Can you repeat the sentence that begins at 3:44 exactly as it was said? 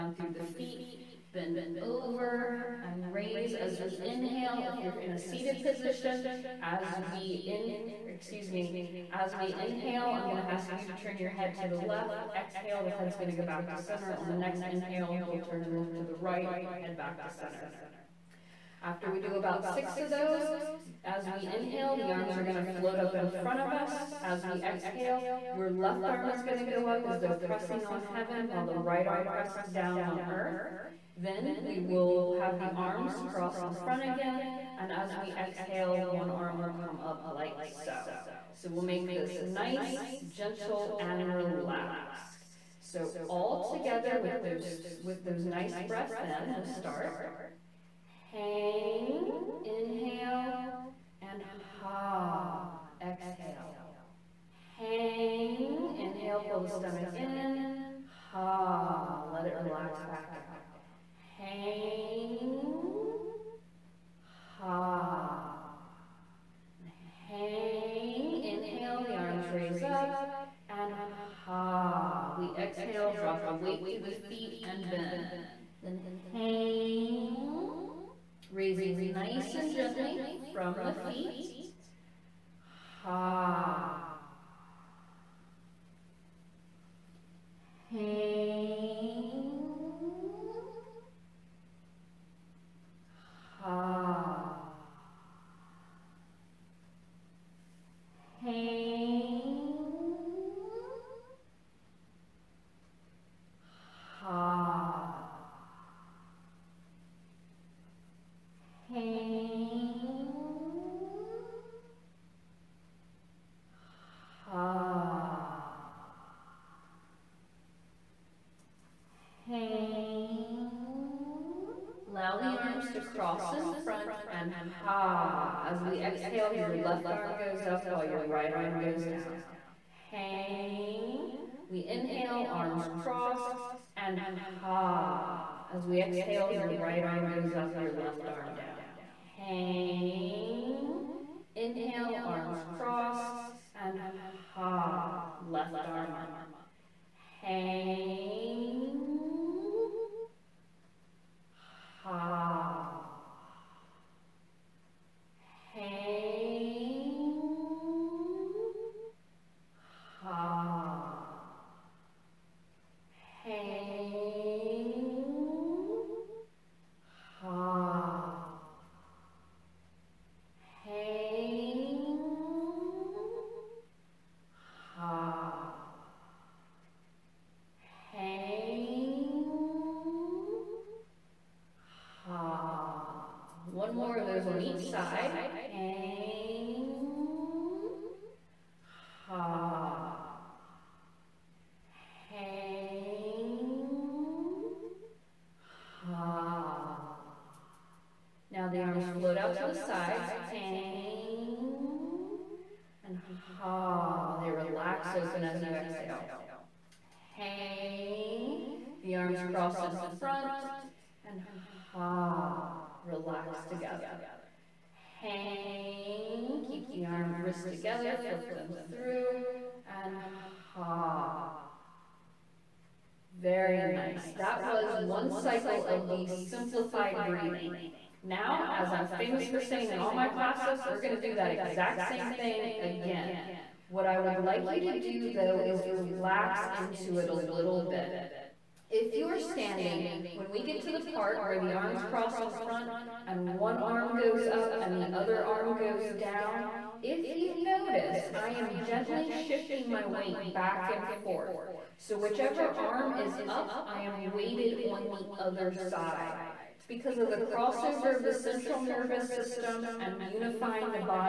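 That was one cycle of the simplified breathing.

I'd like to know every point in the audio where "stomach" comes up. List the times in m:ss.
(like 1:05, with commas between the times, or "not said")
0:56.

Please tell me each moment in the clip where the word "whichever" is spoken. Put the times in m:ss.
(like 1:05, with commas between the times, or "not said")
4:12.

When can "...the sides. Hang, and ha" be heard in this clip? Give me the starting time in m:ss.
3:19.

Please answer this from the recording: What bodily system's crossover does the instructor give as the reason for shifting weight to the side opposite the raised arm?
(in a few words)
central nervous system.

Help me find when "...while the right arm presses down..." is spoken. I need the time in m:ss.
0:28.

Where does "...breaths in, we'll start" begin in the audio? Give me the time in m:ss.
0:45.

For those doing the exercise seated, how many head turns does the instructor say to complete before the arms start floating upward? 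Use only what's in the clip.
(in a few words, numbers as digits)
6.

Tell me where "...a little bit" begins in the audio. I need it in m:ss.
3:57.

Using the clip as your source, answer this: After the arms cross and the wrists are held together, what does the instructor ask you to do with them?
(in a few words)
flip them through.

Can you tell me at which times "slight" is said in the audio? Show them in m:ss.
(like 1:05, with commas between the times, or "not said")
not said.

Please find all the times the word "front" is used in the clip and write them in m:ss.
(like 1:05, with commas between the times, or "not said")
0:23, 0:33, 2:03, 3:30, 4:02.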